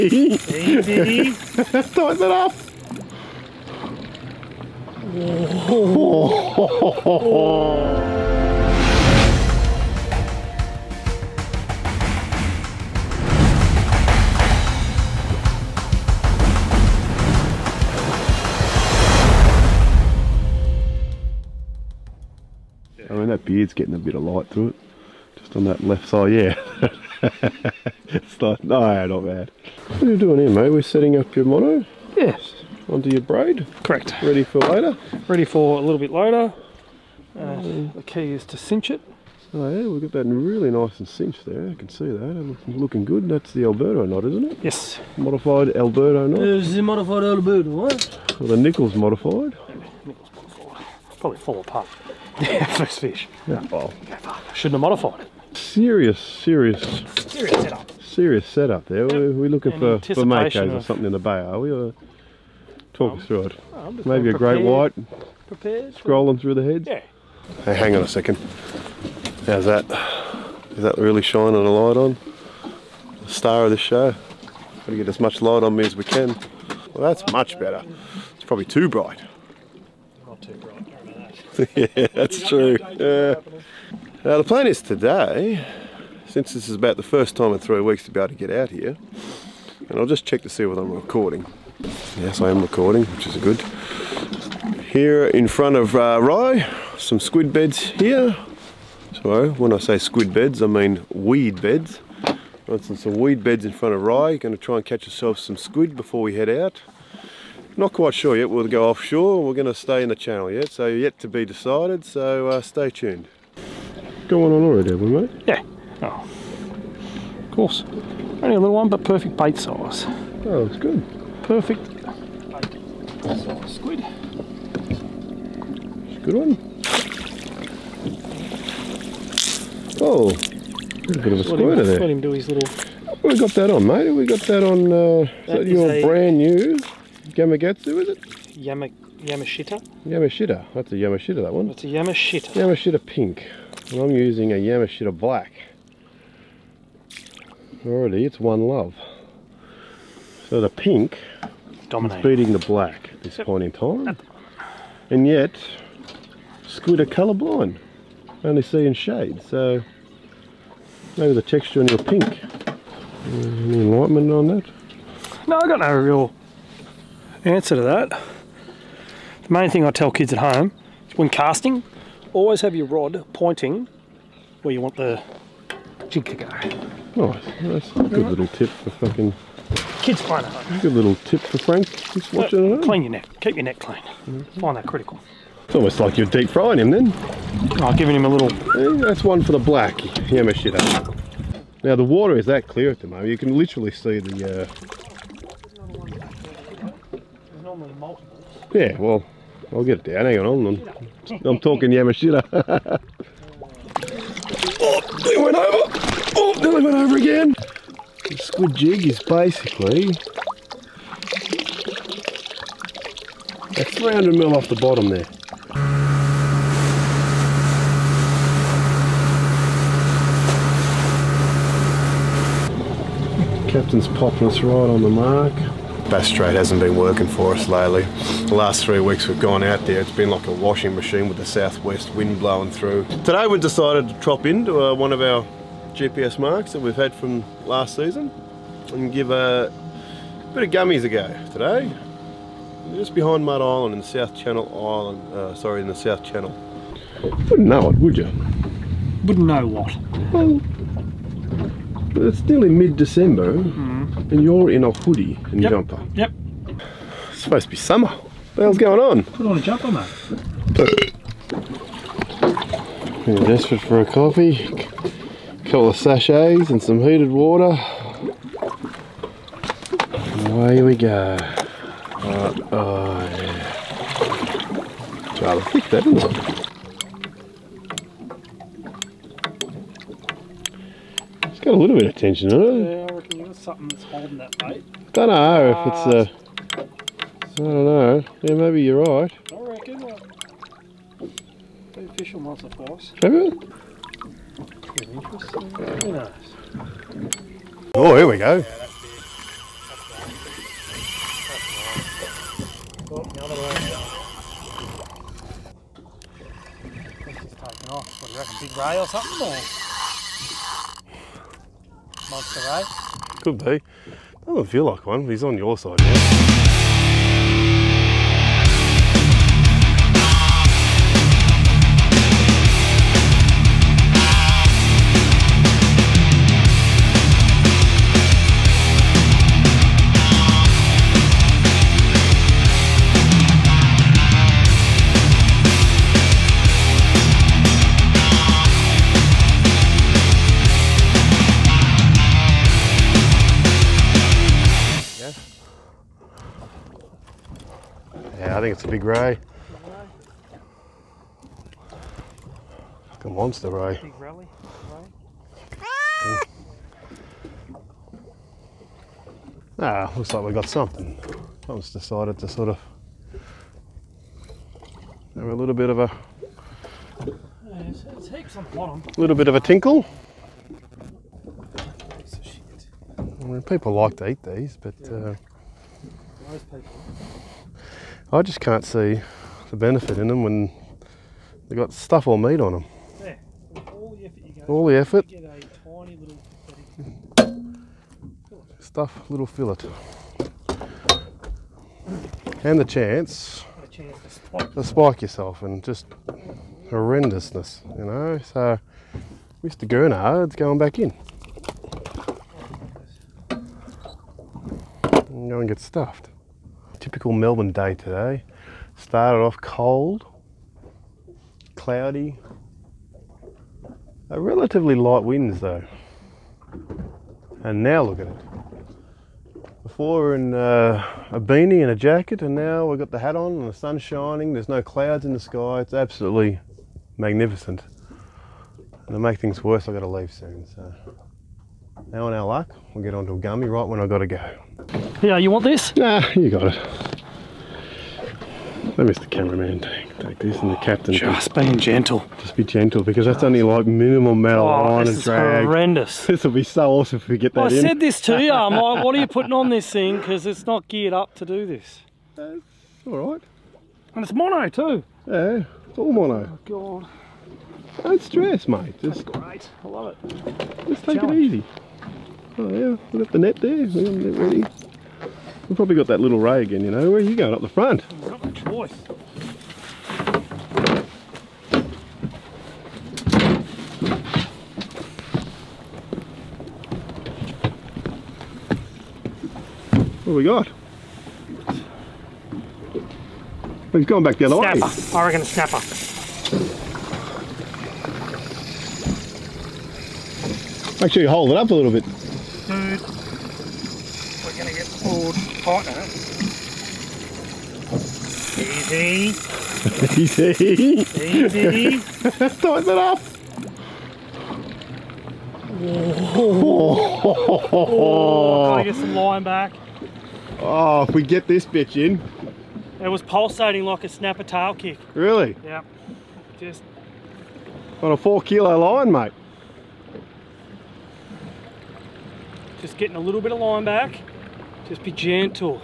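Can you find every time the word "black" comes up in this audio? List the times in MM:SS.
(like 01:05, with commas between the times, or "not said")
02:25, 02:32, 03:09.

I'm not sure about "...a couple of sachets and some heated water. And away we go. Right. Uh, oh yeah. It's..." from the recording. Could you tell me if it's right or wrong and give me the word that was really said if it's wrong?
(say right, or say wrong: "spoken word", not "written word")
right.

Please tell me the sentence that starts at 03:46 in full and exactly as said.
Bass Strait hasn't been working for us lately.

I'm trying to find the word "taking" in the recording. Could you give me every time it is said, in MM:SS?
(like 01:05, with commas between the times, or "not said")
05:07.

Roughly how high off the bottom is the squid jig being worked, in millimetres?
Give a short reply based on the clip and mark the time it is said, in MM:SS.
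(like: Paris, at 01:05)
300, at 03:33.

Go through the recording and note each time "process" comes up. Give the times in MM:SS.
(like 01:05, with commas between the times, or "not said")
not said.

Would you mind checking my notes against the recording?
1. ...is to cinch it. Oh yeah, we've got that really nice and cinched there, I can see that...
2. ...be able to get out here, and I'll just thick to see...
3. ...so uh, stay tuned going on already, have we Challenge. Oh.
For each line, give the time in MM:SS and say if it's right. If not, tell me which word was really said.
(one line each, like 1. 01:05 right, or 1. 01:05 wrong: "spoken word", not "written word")
1. 00:38 right
2. 01:28 wrong: "check", not "thick"
3. 01:52 wrong: "Yeah", not "Challenge".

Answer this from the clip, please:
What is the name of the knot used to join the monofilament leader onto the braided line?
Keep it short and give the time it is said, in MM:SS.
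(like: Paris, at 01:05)
Modified Alberto knot, at 00:45.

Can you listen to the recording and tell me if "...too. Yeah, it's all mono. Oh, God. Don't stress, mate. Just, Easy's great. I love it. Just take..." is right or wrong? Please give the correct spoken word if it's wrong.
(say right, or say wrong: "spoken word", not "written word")
wrong: "That", not "Easy".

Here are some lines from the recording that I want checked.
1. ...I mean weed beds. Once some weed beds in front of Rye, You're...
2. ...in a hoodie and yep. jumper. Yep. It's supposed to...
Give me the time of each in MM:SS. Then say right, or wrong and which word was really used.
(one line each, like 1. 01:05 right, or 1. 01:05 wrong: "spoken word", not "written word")
1. 01:40 right
2. 04:14 right.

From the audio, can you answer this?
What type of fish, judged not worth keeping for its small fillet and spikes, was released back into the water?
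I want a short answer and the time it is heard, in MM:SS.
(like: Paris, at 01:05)
Gurnard, at 06:39.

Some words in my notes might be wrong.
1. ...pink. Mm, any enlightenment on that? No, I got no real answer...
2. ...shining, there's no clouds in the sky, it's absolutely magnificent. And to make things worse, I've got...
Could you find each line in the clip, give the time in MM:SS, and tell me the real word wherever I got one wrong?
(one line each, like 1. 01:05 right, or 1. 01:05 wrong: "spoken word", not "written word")
1. 02:41 right
2. 07:04 right.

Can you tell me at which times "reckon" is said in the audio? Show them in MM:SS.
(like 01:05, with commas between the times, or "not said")
04:43, 04:49, 05:08.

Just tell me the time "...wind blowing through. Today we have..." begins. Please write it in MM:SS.
03:52.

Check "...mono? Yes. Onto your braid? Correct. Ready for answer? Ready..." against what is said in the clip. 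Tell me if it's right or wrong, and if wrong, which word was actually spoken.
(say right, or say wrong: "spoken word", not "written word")
wrong: "later", not "answer".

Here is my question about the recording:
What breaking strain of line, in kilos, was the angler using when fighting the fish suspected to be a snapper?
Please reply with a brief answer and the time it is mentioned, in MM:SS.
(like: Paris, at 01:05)
4 kilo, at 08:38.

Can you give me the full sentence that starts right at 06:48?
Started off cold, cloudy, a relatively light winds though.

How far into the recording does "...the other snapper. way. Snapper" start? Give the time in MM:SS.
08:04.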